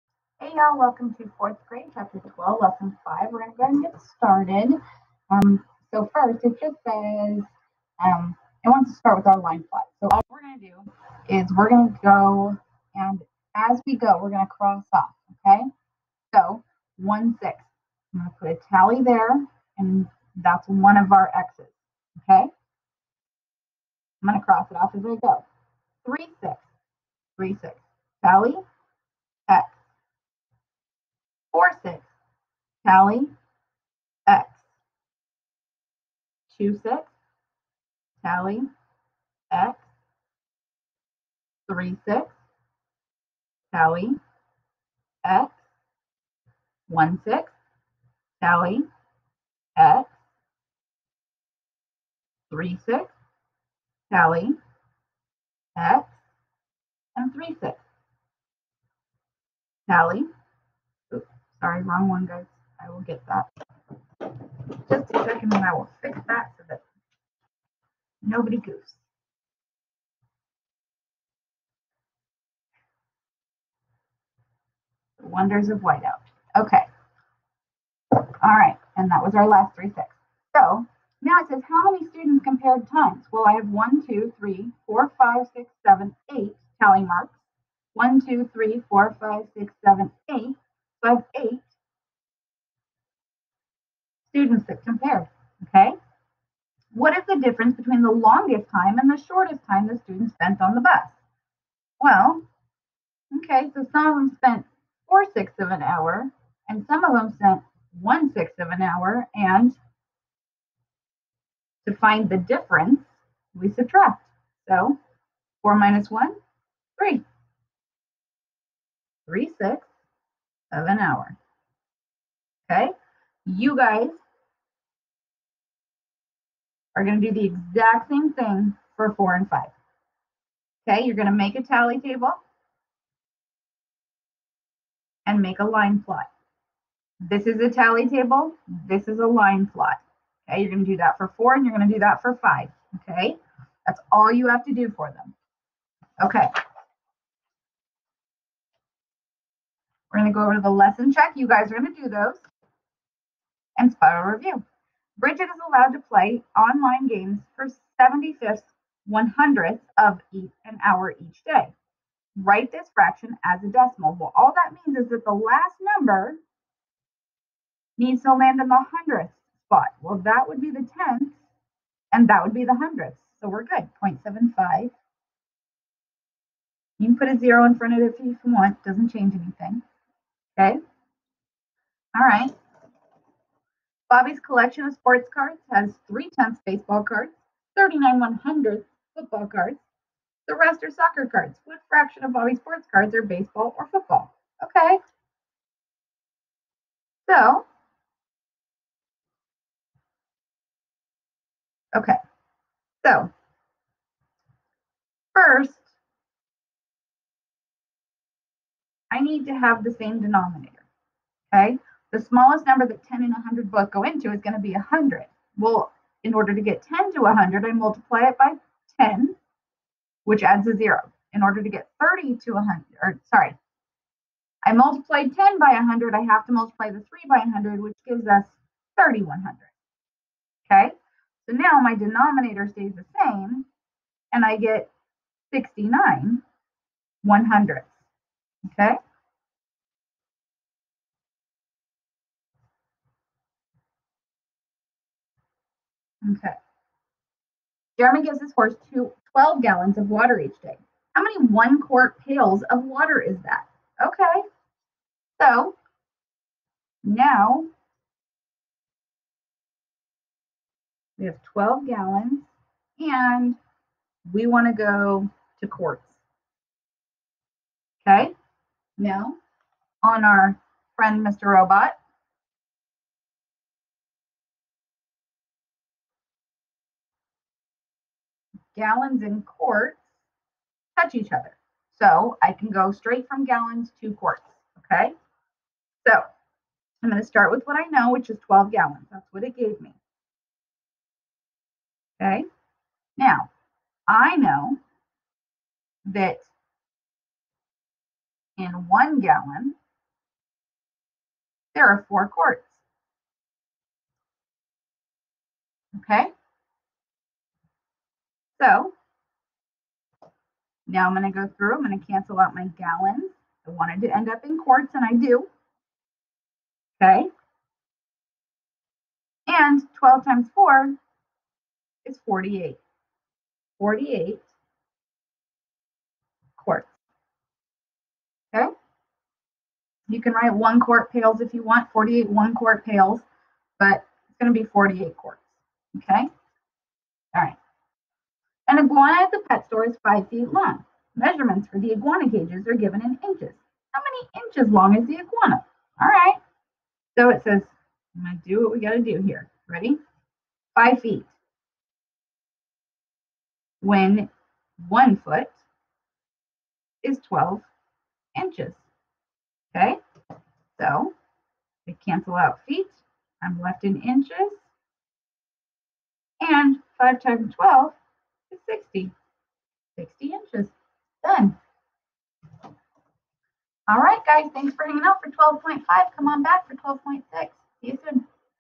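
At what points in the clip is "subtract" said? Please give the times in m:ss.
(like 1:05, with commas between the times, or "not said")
1:53.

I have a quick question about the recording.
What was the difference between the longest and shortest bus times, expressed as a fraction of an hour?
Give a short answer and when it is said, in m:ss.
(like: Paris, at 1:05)
3/6 of an hour, at 1:59.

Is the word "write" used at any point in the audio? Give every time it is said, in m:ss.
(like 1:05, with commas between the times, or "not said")
2:42, 5:30.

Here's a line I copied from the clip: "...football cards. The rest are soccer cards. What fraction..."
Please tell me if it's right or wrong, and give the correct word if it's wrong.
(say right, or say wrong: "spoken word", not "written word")
right.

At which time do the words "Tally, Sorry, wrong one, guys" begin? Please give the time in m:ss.
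0:59.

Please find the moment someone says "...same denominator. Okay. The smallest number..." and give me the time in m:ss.
3:29.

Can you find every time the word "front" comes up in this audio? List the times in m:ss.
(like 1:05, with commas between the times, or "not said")
2:57.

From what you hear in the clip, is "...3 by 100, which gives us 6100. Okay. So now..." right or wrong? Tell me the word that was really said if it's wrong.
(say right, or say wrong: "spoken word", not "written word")
wrong: "3100", not "6100".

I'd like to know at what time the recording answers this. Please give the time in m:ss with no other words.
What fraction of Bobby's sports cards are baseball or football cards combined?
3:55.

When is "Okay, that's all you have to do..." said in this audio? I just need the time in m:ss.
2:23.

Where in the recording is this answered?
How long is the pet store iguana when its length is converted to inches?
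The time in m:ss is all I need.
6:09.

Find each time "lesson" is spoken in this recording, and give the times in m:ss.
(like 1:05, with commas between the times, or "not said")
0:02, 2:30.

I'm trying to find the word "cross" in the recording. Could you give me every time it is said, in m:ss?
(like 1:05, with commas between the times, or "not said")
0:14, 0:24.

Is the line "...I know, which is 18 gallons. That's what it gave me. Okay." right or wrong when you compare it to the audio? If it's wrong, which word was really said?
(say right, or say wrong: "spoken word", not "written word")
wrong: "12", not "18".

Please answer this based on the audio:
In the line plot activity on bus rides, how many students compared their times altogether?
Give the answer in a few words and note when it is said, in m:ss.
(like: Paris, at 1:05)
8, at 1:30.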